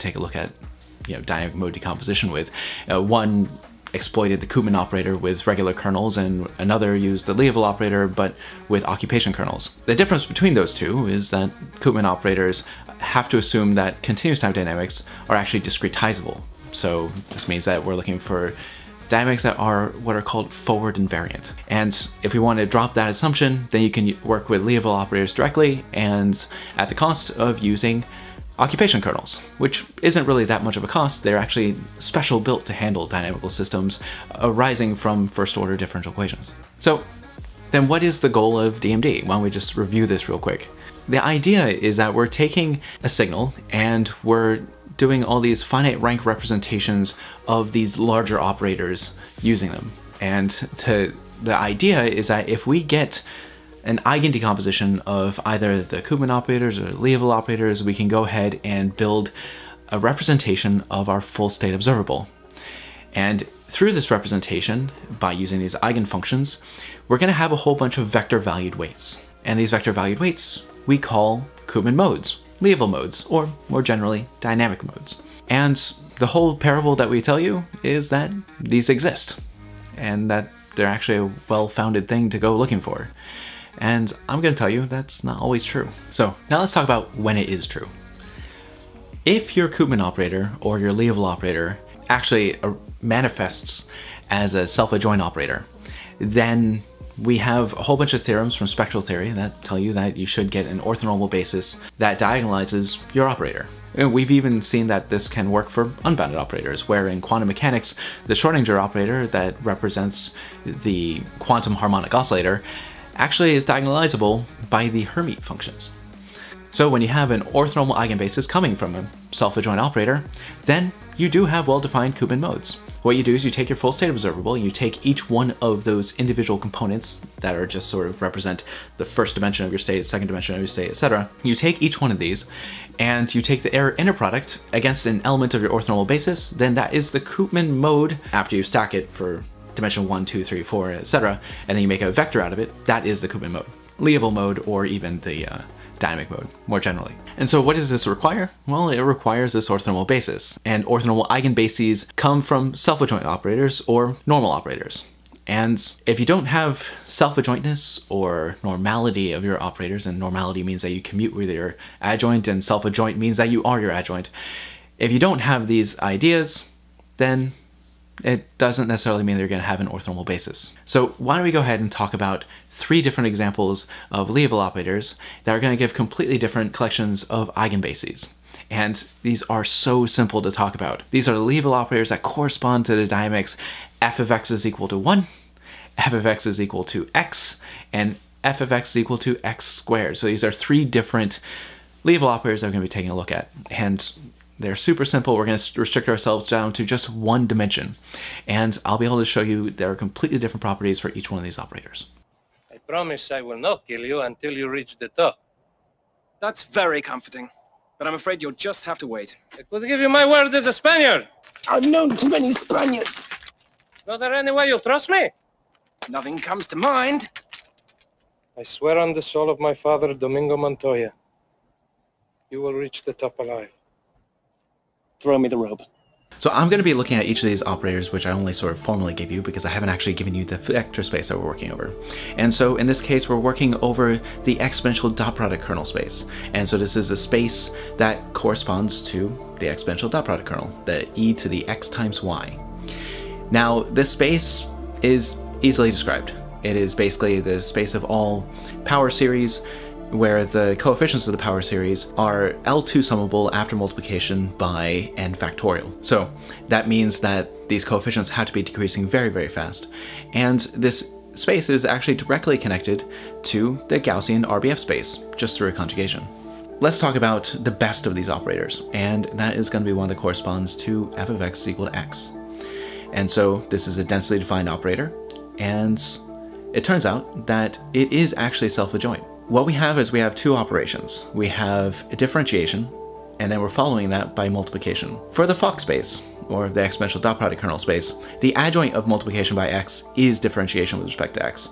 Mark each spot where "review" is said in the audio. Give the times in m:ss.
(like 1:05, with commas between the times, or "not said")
0:39.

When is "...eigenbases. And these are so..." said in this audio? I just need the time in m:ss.
2:57.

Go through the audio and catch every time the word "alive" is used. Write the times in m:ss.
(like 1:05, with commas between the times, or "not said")
3:43.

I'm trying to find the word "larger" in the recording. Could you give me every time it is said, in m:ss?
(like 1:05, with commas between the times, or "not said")
0:47.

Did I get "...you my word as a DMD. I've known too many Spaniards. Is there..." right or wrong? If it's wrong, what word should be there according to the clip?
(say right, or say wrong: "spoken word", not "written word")
wrong: "Spaniard", not "DMD".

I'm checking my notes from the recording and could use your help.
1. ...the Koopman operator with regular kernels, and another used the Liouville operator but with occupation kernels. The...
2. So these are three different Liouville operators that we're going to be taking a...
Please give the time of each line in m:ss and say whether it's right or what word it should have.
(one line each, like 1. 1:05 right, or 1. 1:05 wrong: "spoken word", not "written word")
1. 0:04 right
2. 3:10 right.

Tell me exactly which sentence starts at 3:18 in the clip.
And I'll be able to show you there are completely different properties for each one of these operators.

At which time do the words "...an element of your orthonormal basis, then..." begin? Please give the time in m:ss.
2:15.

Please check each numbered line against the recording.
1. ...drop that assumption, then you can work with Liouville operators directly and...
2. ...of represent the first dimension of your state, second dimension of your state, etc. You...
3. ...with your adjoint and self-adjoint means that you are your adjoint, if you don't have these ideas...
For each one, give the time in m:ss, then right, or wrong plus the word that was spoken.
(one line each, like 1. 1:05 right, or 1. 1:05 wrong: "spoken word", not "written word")
1. 0:22 right
2. 2:08 right
3. 2:41 right.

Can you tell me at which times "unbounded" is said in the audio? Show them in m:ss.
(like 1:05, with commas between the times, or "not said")
1:46.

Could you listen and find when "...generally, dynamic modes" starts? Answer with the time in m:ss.
1:13.